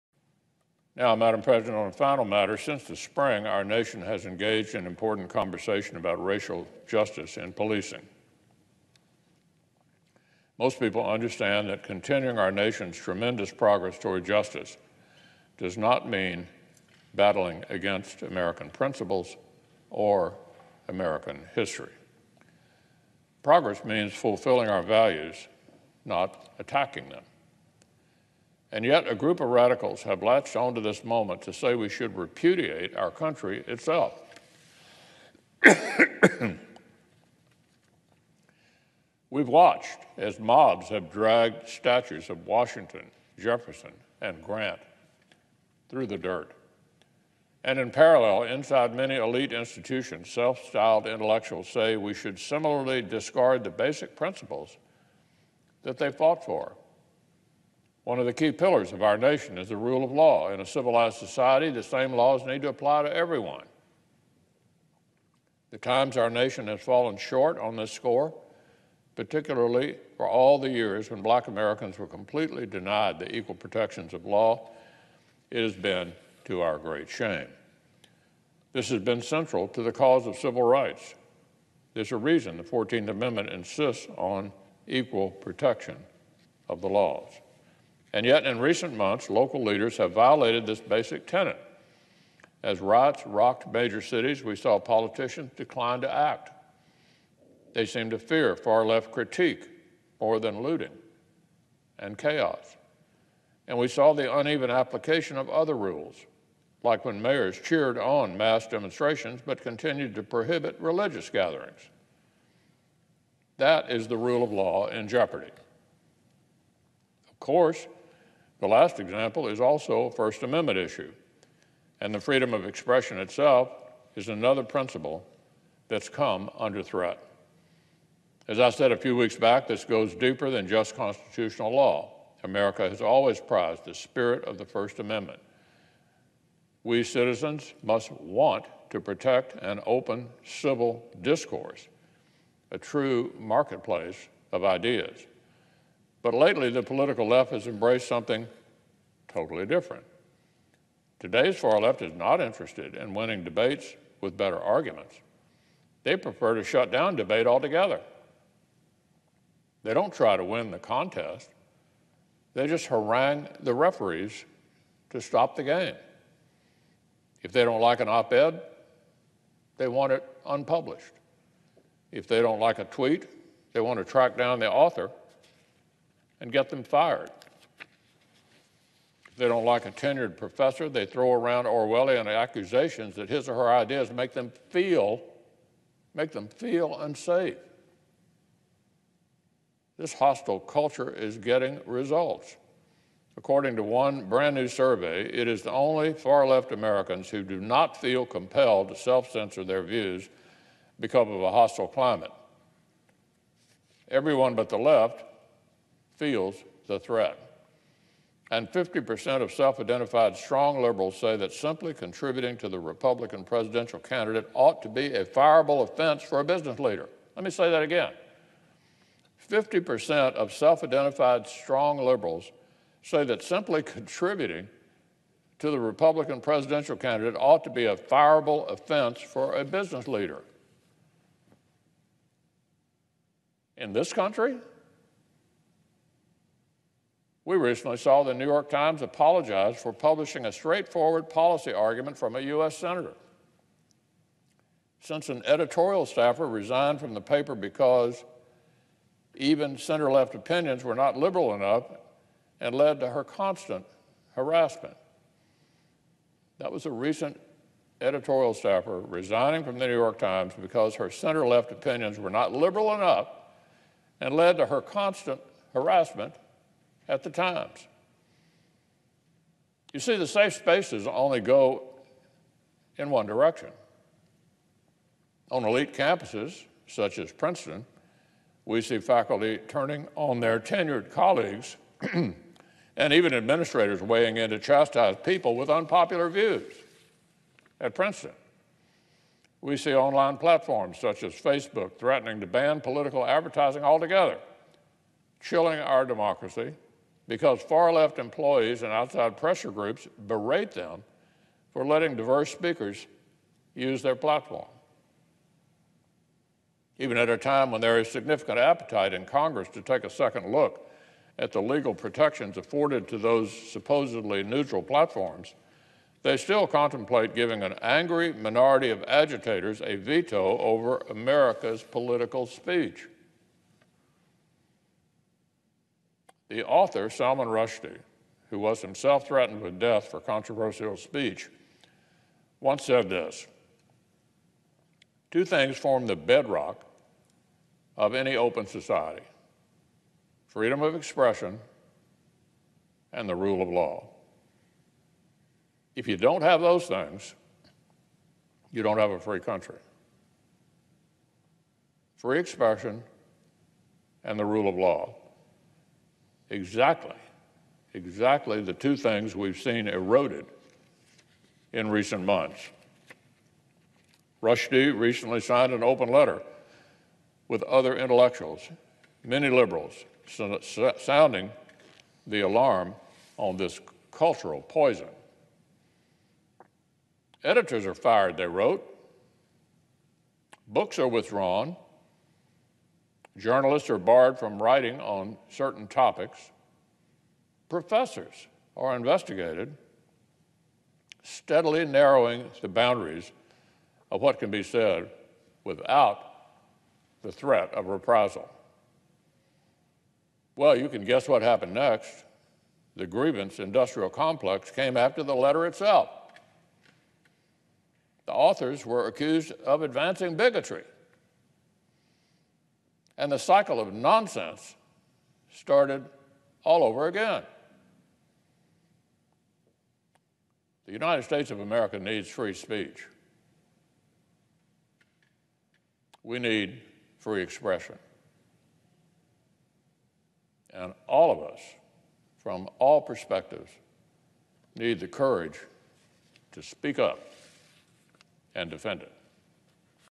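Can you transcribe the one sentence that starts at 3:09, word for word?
This hostile culture is getting results.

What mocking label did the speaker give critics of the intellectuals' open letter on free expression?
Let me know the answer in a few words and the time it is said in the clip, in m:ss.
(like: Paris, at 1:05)
grievance industrial complex, at 6:43.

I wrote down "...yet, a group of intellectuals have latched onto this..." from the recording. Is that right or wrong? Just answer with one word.
wrong.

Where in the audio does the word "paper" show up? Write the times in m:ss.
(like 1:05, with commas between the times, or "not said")
4:07.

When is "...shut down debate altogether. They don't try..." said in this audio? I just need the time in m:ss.
2:36.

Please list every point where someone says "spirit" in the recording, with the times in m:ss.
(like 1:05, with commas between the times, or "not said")
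2:13.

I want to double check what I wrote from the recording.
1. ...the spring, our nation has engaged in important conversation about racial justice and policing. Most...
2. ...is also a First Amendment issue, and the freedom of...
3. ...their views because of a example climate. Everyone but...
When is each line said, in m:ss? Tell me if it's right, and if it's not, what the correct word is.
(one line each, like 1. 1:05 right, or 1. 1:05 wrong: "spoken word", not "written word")
1. 0:02 right
2. 1:59 right
3. 3:19 wrong: "hostile", not "example".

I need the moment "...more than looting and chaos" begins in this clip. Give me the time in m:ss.
1:40.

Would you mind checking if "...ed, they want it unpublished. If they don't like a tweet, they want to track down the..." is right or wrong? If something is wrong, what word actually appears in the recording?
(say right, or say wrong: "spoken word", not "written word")
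right.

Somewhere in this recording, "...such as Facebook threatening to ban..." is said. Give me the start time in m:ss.
4:50.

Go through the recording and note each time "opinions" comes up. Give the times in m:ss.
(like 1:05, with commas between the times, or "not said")
4:10, 4:21.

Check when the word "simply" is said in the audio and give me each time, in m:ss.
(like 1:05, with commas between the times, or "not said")
3:31, 3:43.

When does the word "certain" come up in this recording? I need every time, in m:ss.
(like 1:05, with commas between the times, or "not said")
6:25.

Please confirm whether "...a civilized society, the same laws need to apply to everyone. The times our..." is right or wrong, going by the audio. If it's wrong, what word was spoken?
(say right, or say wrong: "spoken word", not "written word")
right.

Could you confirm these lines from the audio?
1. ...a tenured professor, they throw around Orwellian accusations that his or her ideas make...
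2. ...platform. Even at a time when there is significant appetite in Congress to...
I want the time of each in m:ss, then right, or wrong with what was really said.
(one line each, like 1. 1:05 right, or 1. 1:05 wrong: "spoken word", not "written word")
1. 2:59 right
2. 5:04 right.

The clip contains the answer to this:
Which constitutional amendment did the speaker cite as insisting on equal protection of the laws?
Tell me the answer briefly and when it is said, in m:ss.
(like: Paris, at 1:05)
14th Amendment, at 1:22.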